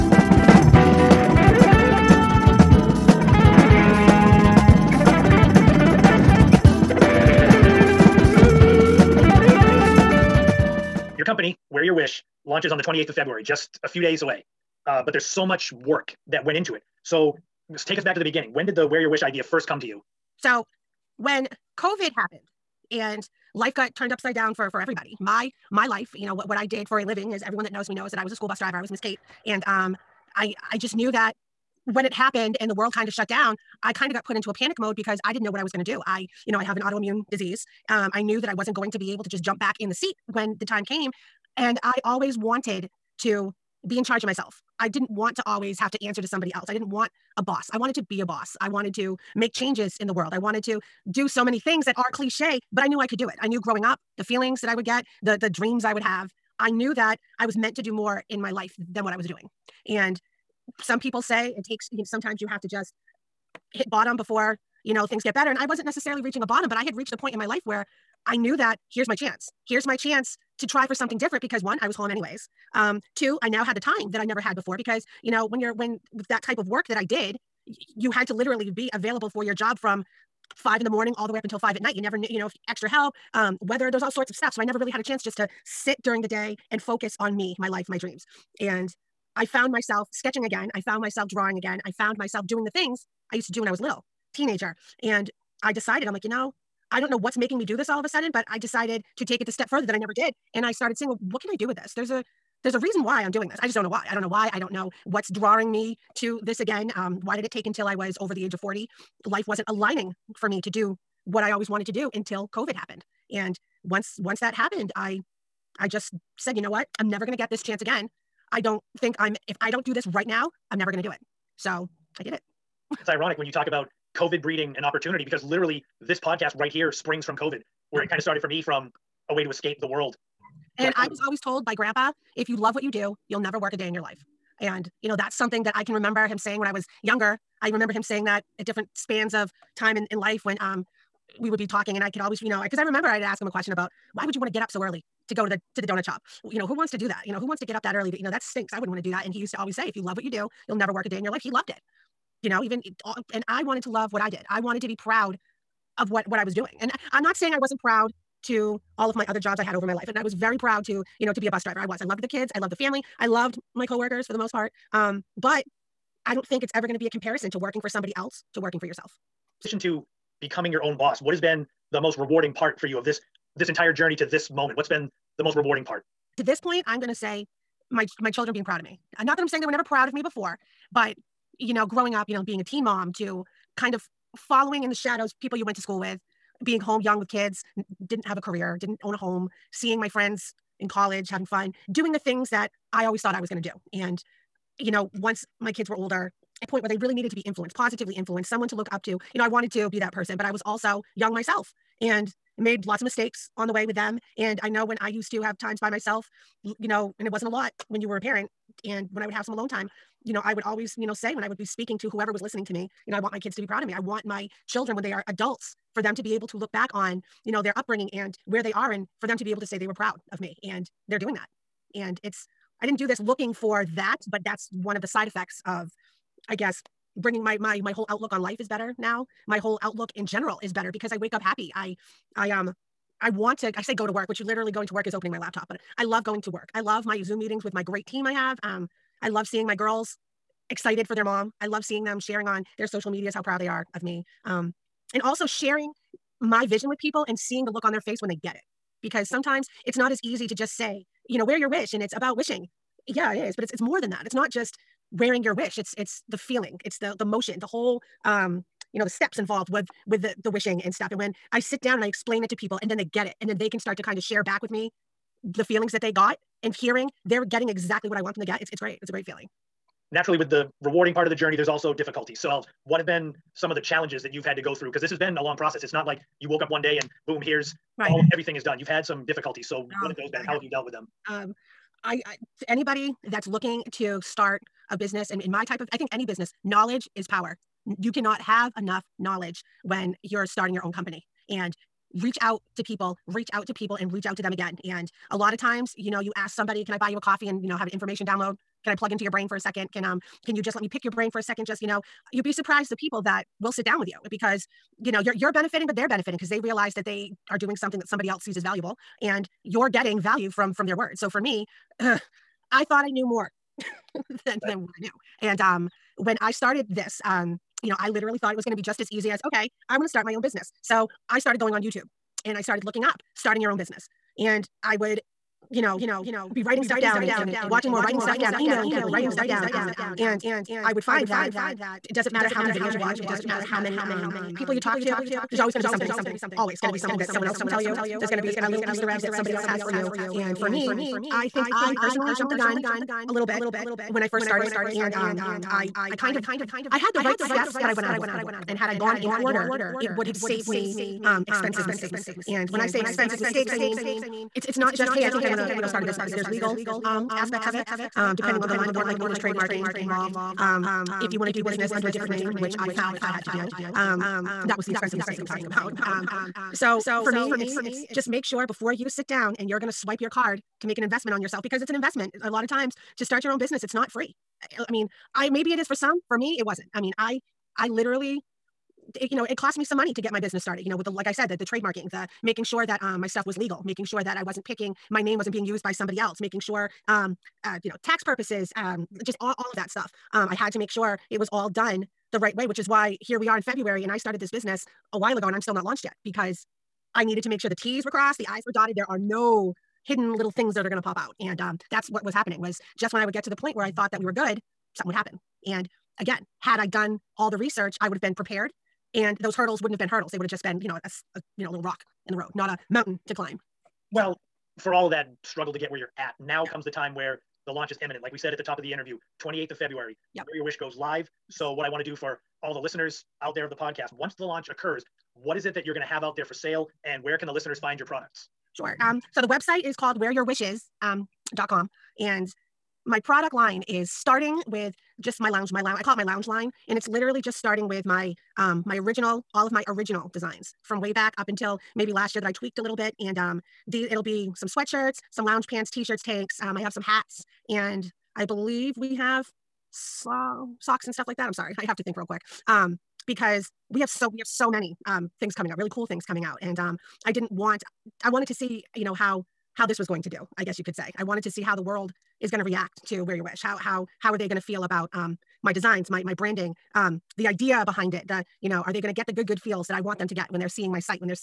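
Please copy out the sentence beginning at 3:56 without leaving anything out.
I love my Zoom meetings with my great team I have.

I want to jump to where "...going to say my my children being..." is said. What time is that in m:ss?
2:56.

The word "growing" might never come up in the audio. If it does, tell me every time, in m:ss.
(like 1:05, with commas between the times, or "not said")
0:53, 3:01.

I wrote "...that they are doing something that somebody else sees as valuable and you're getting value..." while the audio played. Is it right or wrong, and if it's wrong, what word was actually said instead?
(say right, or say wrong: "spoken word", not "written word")
right.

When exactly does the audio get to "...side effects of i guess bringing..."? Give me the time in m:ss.
3:45.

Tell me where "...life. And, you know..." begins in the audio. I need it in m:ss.
2:14.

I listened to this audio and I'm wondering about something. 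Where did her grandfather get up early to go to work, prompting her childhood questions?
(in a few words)
Donut shop.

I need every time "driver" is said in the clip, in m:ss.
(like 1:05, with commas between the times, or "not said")
0:28, 2:41.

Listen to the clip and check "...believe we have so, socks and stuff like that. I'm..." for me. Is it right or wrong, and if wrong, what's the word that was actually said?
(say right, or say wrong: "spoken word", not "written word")
right.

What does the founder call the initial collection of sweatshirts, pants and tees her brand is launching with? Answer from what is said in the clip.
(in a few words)
Lounge line.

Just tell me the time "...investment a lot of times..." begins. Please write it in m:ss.
6:11.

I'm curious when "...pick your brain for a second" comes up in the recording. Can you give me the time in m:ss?
5:00.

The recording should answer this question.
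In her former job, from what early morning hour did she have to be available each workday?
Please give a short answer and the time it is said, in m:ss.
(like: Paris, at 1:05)
5 in the morning, at 1:20.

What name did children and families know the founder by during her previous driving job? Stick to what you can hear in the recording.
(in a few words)
Miss Kate.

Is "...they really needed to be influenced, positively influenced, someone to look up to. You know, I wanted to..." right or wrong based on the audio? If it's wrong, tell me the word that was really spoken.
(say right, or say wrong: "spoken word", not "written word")
right.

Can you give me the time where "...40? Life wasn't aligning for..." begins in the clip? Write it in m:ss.
1:48.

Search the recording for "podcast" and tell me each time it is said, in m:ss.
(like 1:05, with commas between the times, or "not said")
2:06, 7:03.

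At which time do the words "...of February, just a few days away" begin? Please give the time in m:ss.
0:13.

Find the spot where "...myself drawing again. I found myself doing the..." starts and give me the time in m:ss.
1:31.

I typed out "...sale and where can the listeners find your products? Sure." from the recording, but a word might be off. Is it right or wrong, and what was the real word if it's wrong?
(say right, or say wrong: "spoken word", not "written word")
right.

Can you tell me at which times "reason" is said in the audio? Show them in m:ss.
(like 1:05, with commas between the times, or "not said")
1:42.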